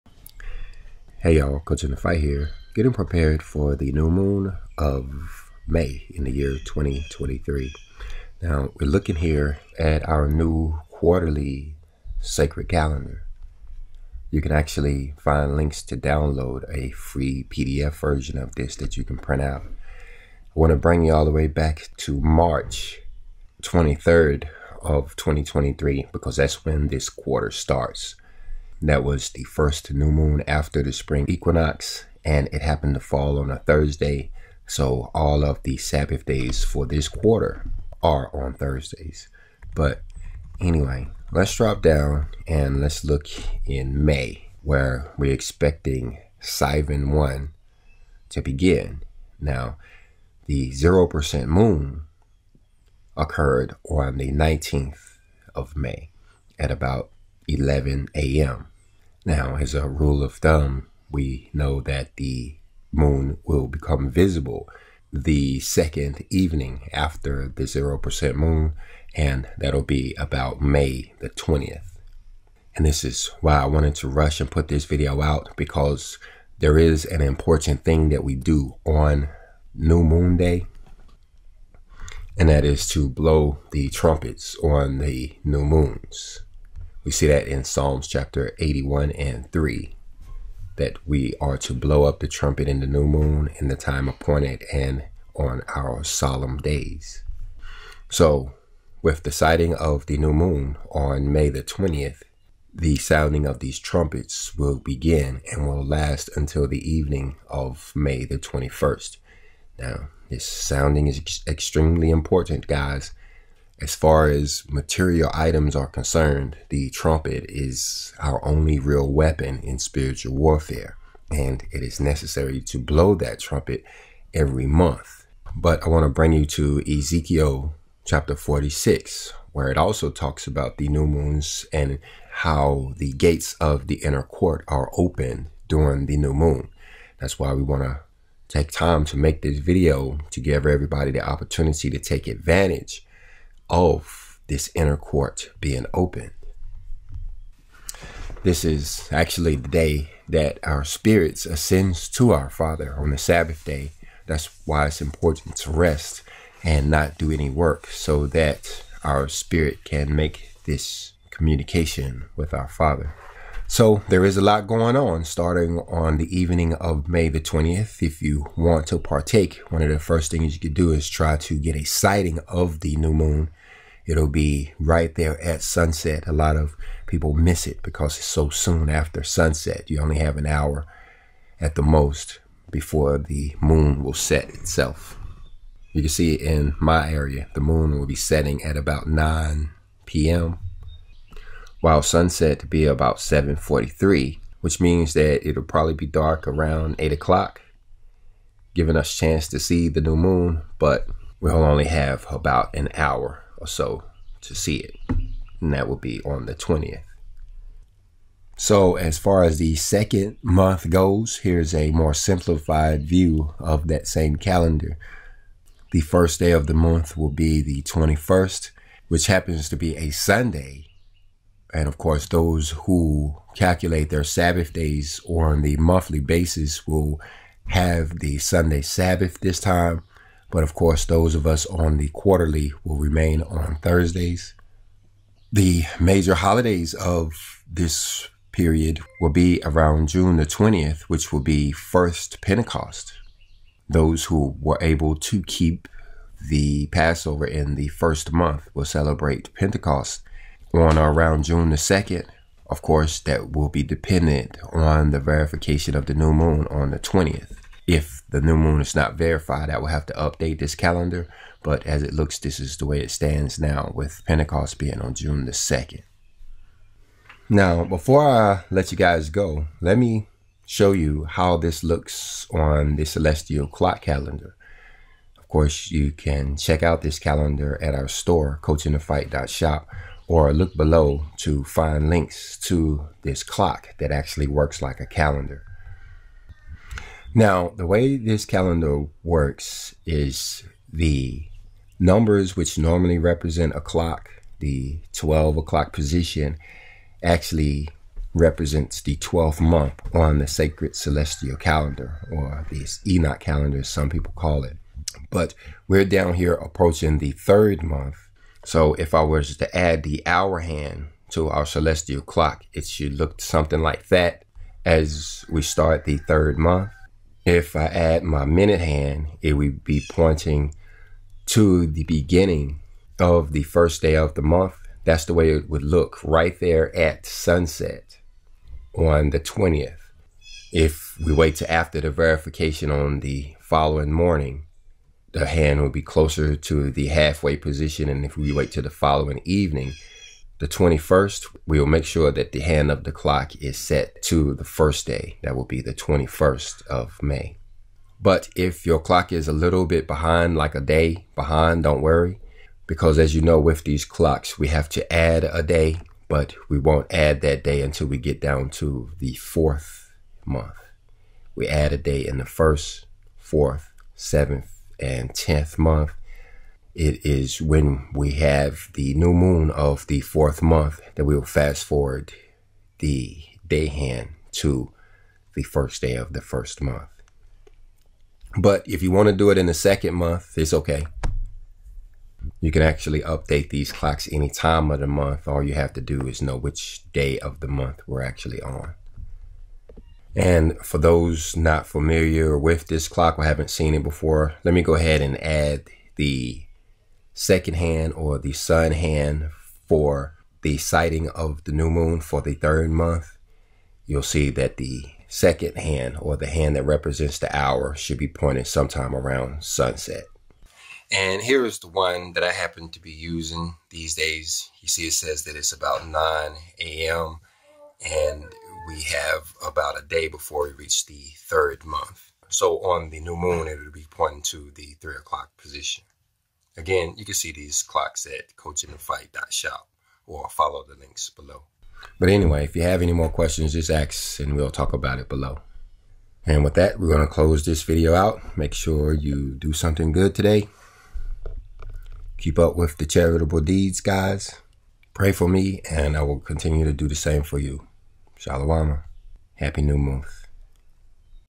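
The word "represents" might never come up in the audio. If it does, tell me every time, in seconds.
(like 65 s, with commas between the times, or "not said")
293 s, 298 s, 406 s.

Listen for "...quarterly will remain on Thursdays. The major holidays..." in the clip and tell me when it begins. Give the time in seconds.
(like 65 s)
232 s.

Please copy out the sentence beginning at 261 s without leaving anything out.
But as it looks, this is the way it stands now, with Pentecost being on June the 2nd.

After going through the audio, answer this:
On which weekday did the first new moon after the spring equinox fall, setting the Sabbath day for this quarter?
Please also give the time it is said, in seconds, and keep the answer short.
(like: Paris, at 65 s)
Thursday, at 33 s.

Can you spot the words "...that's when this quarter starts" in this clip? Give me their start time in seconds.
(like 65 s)
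26 s.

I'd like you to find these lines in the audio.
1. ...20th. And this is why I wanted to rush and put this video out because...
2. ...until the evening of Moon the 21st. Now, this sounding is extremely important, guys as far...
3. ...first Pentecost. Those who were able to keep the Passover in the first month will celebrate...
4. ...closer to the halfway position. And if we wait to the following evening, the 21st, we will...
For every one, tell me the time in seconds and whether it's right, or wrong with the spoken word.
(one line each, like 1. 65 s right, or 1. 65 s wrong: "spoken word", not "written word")
1. 71 s right
2. 106 s wrong: "May", not "Moon"
3. 241 s right
4. 336 s right.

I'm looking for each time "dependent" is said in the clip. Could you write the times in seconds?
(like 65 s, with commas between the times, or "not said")
253 s.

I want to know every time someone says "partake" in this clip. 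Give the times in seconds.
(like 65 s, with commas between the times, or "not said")
168 s.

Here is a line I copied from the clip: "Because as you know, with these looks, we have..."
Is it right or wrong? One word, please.
wrong.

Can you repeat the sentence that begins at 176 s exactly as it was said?
A lot of people miss it because it's so soon after sunset.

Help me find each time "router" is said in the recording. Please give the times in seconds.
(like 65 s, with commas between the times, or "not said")
not said.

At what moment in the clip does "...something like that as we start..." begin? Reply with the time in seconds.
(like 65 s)
313 s.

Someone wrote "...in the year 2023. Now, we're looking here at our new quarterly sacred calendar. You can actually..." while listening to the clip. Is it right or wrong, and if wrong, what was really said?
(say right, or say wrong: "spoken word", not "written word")
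right.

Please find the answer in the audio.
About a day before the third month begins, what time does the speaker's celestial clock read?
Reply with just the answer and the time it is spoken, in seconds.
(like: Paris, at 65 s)
9 a.m., at 416 s.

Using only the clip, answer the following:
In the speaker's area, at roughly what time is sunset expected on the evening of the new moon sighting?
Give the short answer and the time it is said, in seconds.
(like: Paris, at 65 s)
7:43, at 193 s.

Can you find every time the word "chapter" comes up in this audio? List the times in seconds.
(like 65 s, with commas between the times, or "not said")
88 s, 128 s.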